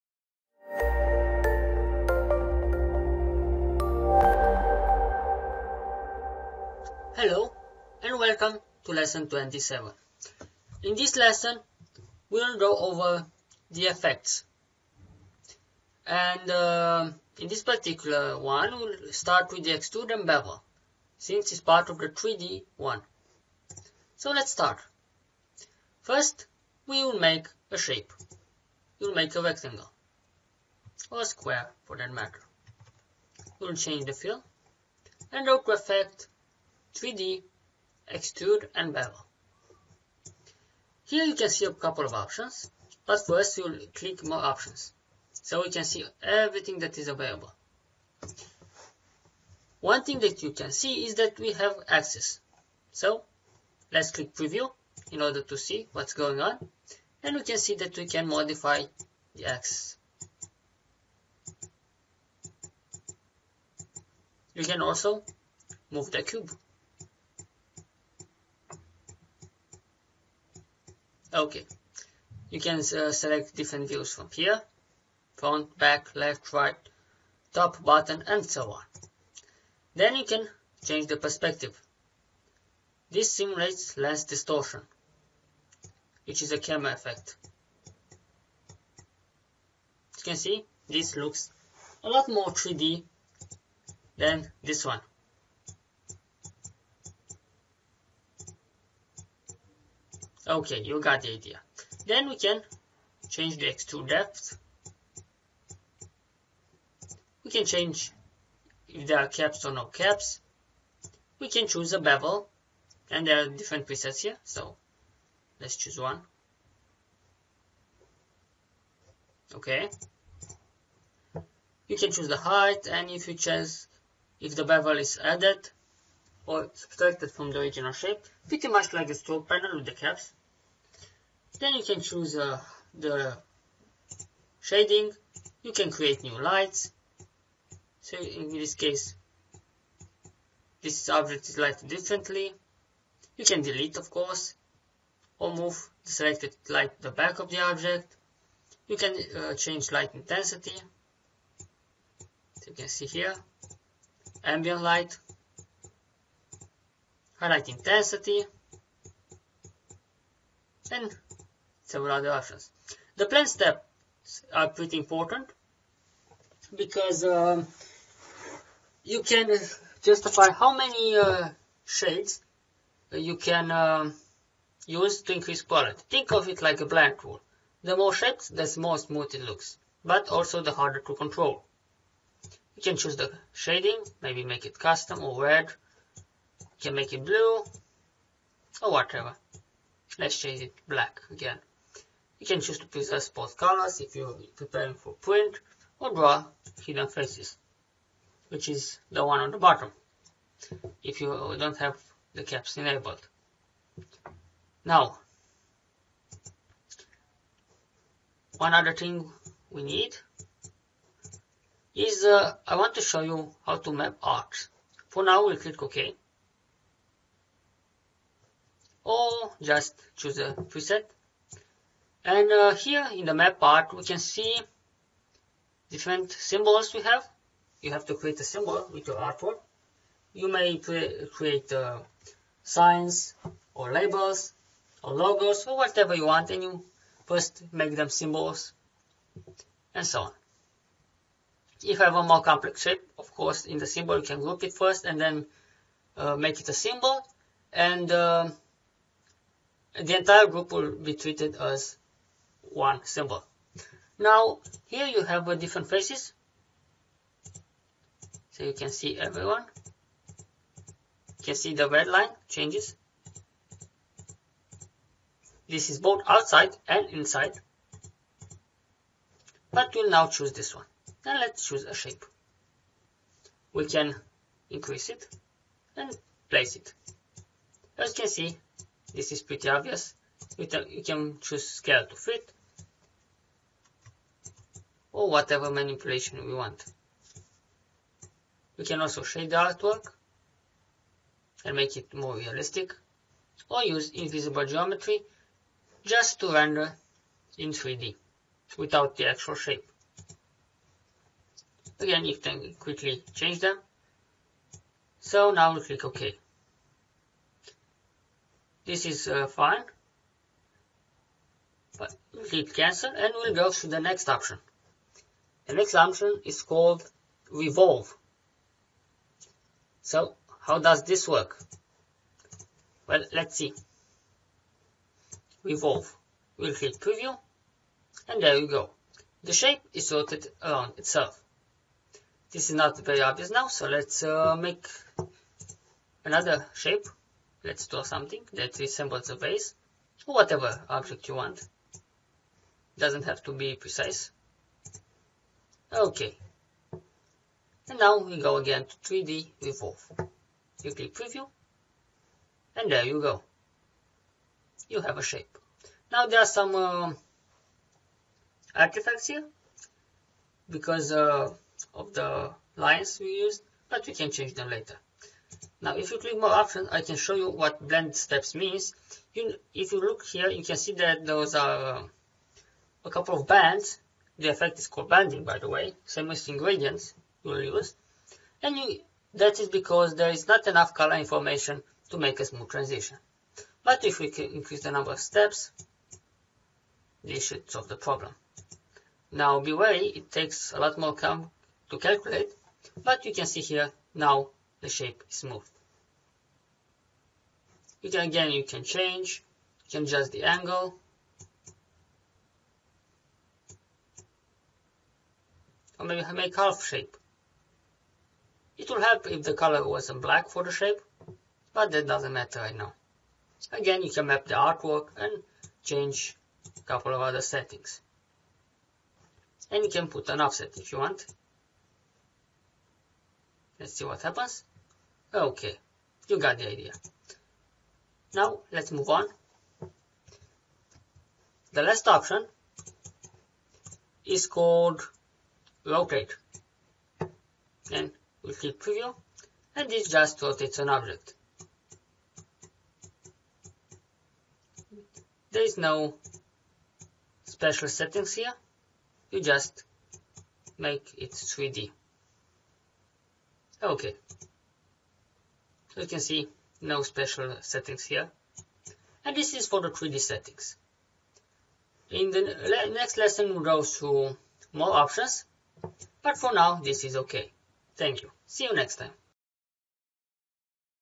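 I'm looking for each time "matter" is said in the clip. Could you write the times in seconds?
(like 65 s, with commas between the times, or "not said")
32 s, 412 s.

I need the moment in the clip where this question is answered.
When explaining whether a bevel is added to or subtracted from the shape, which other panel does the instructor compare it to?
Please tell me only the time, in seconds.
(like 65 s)
129 s.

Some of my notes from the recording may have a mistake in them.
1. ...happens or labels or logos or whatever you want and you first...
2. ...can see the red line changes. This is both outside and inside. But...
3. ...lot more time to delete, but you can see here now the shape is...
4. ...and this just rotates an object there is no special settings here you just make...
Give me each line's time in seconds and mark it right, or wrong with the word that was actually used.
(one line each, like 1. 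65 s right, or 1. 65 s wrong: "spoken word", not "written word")
1. 232 s wrong: "signs", not "happens"
2. 261 s right
3. 390 s wrong: "calculate", not "delete"
4. 439 s right.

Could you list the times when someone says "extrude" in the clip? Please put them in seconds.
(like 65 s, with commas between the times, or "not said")
19 s, 38 s, 103 s.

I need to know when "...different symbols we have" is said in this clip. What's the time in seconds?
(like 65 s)
225 s.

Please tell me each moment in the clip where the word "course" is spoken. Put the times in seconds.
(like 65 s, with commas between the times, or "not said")
144 s, 243 s.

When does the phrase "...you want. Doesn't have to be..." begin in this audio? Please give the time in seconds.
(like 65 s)
341 s.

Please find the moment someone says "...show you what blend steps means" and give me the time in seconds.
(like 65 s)
367 s.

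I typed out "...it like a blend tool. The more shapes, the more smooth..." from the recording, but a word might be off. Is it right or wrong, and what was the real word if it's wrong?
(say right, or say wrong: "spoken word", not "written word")
right.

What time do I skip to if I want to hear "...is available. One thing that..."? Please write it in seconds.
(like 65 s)
46 s.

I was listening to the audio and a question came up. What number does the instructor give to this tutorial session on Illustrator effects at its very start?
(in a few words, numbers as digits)
27.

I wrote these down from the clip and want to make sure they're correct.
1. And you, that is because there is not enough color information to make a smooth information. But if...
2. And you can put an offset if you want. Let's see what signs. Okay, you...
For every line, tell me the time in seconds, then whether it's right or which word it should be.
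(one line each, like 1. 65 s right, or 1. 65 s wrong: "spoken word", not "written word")
1. 378 s wrong: "transition", not "information"
2. 419 s wrong: "happens", not "signs".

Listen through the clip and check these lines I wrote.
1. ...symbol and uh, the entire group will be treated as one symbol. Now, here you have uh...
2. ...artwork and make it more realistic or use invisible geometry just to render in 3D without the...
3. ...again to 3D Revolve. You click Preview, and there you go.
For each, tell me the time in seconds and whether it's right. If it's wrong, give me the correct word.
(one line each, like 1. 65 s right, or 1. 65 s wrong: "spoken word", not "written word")
1. 246 s right
2. 289 s right
3. 348 s right.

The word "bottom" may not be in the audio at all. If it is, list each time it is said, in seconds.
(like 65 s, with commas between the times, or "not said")
77 s, 199 s.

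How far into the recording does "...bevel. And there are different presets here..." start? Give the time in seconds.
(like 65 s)
112 s.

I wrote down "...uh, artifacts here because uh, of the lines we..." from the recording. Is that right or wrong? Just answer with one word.
right.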